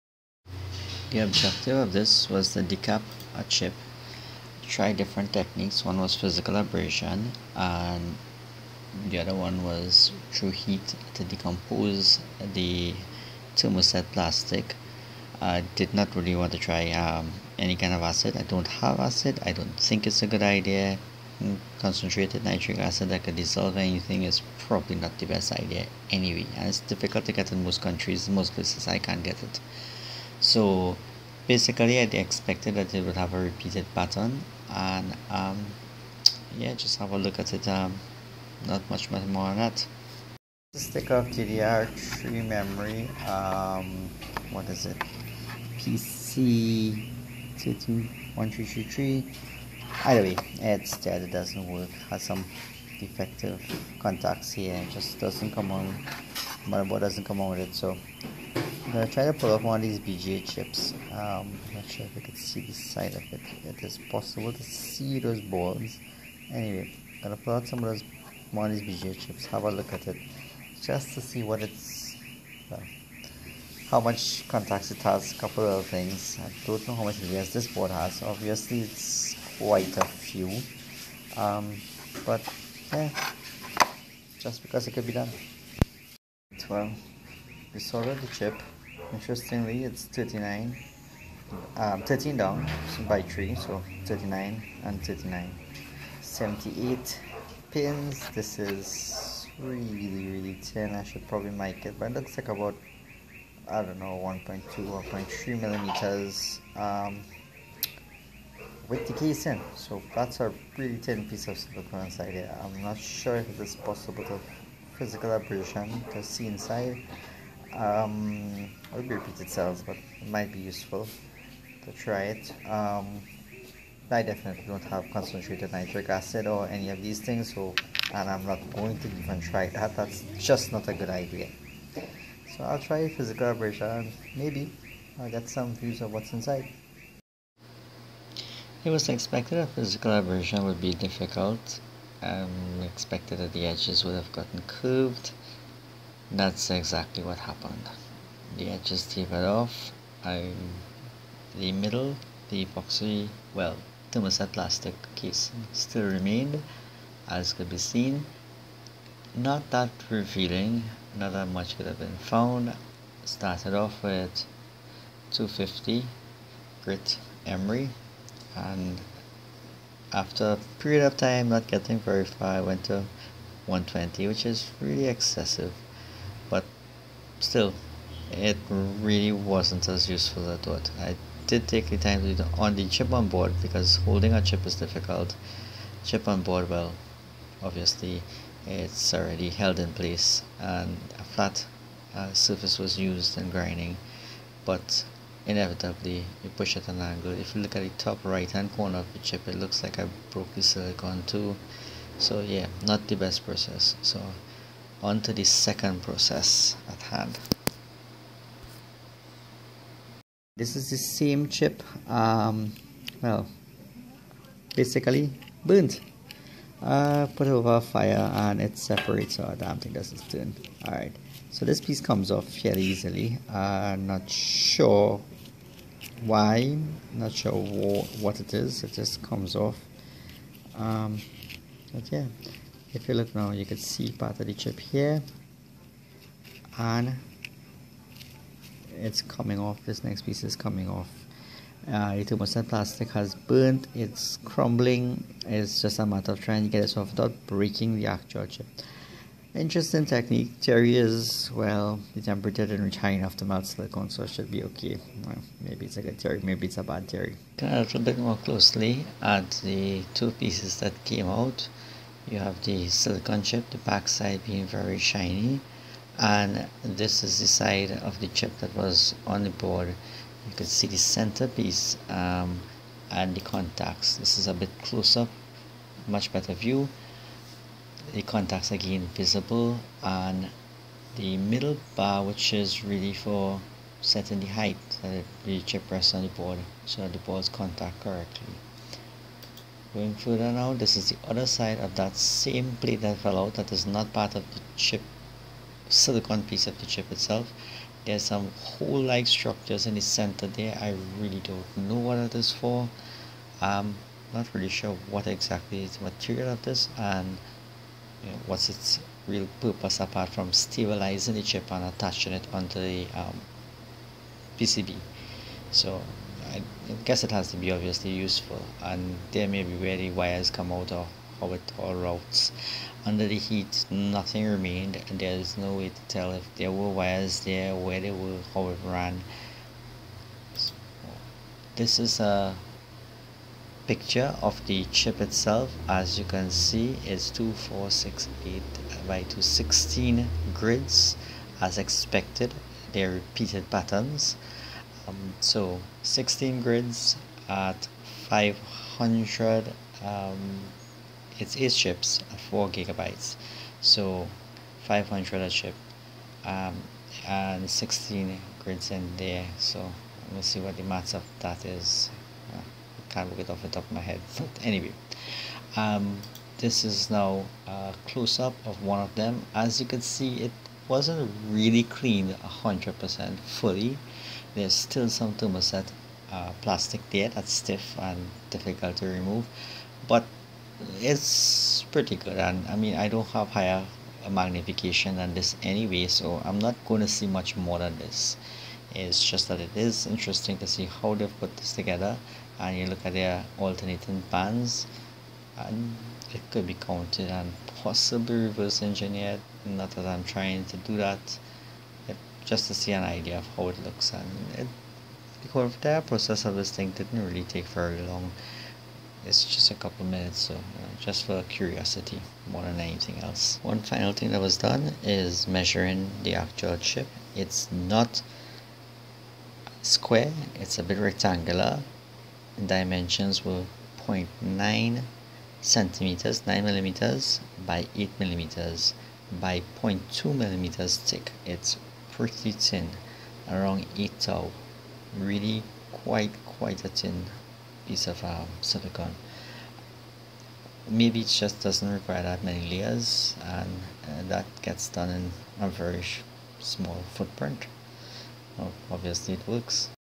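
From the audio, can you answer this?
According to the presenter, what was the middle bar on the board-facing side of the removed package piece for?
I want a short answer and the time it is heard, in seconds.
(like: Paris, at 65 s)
setting the height, at 284 s.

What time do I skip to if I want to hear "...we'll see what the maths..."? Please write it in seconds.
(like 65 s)
360 s.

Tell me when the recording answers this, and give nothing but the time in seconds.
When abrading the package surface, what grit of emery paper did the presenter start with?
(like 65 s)
165 s.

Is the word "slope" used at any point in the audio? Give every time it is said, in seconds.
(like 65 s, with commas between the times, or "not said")
not said.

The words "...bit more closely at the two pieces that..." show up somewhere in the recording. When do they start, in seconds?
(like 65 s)
258 s.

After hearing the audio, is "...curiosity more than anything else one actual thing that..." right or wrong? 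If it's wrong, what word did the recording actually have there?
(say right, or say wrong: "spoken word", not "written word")
wrong: "final", not "actual".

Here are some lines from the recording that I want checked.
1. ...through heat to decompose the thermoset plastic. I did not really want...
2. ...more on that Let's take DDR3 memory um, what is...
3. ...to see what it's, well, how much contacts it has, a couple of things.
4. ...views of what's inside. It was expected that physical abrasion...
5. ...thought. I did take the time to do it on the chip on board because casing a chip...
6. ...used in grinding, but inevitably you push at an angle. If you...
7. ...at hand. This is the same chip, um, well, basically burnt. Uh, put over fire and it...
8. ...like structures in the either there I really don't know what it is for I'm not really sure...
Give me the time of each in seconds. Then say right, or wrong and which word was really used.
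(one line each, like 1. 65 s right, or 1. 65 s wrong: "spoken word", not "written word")
1. 10 s right
2. 39 s right
3. 71 s right
4. 135 s right
5. 180 s wrong: "holding", not "casing"
6. 192 s right
7. 206 s right
8. 299 s wrong: "center", not "either".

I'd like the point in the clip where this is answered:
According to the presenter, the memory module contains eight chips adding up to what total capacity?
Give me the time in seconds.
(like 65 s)
352 s.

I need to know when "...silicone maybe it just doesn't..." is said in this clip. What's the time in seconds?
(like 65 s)
438 s.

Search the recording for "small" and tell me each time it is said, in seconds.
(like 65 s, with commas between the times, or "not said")
446 s.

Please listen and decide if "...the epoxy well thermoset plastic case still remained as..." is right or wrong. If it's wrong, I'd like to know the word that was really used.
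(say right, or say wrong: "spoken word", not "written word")
right.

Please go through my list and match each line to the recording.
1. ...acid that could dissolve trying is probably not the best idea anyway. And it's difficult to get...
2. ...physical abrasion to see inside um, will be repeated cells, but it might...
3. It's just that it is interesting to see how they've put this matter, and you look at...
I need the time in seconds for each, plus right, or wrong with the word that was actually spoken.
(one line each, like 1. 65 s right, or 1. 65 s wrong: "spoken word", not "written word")
1. 22 s wrong: "anything", not "trying"
2. 114 s right
3. 388 s wrong: "together", not "matter".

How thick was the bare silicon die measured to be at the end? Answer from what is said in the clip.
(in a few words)
0.2 millimeters.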